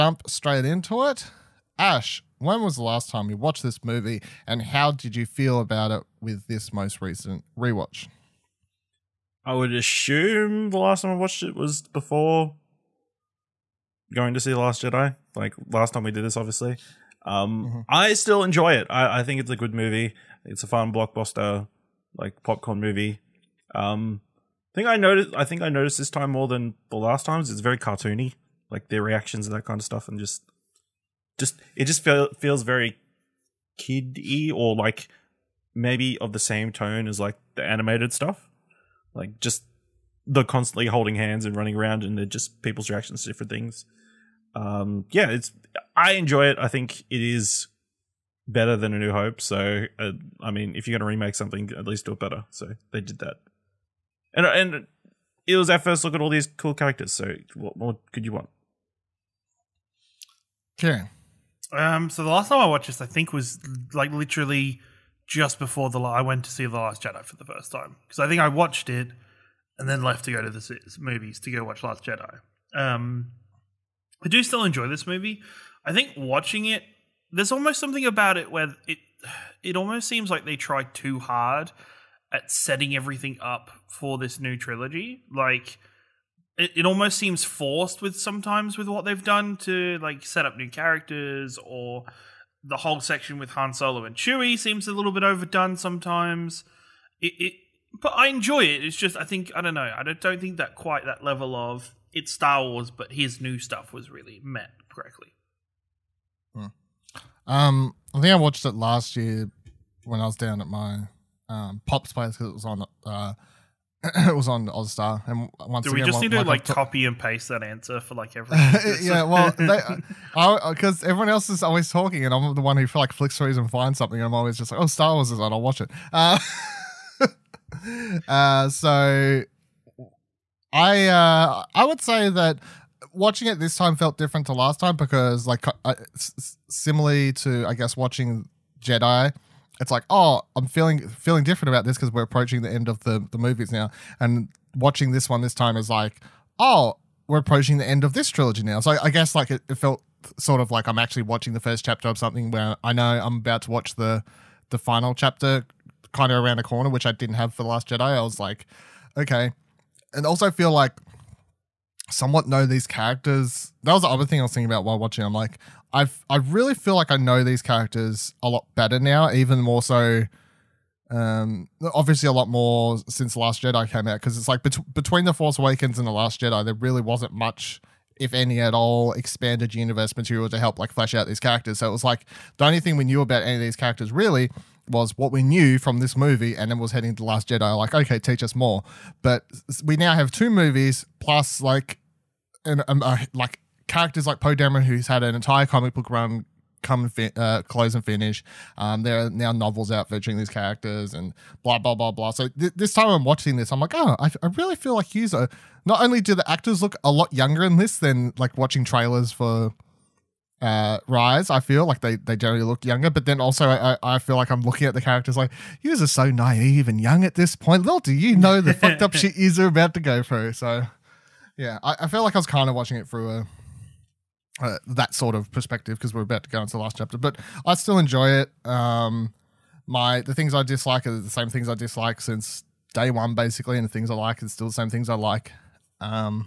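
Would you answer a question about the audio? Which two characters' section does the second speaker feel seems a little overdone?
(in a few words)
Han Solo and Chewie.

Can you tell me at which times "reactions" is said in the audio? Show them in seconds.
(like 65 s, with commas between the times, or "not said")
29 s, 42 s.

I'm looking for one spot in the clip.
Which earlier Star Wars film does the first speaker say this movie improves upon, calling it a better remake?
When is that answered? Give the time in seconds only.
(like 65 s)
48 s.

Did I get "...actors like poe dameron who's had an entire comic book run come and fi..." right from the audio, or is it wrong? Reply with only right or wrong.
wrong.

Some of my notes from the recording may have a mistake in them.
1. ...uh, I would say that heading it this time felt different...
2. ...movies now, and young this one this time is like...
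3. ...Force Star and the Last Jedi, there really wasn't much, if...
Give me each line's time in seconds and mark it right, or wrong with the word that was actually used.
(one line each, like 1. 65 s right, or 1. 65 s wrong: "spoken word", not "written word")
1. 131 s wrong: "watching", not "heading"
2. 143 s wrong: "watching", not "young"
3. 175 s wrong: "Awakens", not "Star".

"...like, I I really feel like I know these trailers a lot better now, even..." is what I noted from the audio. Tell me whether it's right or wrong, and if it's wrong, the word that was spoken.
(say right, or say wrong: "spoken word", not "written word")
wrong: "characters", not "trailers".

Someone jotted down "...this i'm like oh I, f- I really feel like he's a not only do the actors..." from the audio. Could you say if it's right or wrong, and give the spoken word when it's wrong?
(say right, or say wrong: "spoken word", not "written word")
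right.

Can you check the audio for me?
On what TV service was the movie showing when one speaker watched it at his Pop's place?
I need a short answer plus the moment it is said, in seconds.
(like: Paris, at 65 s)
Ozstar, at 114 s.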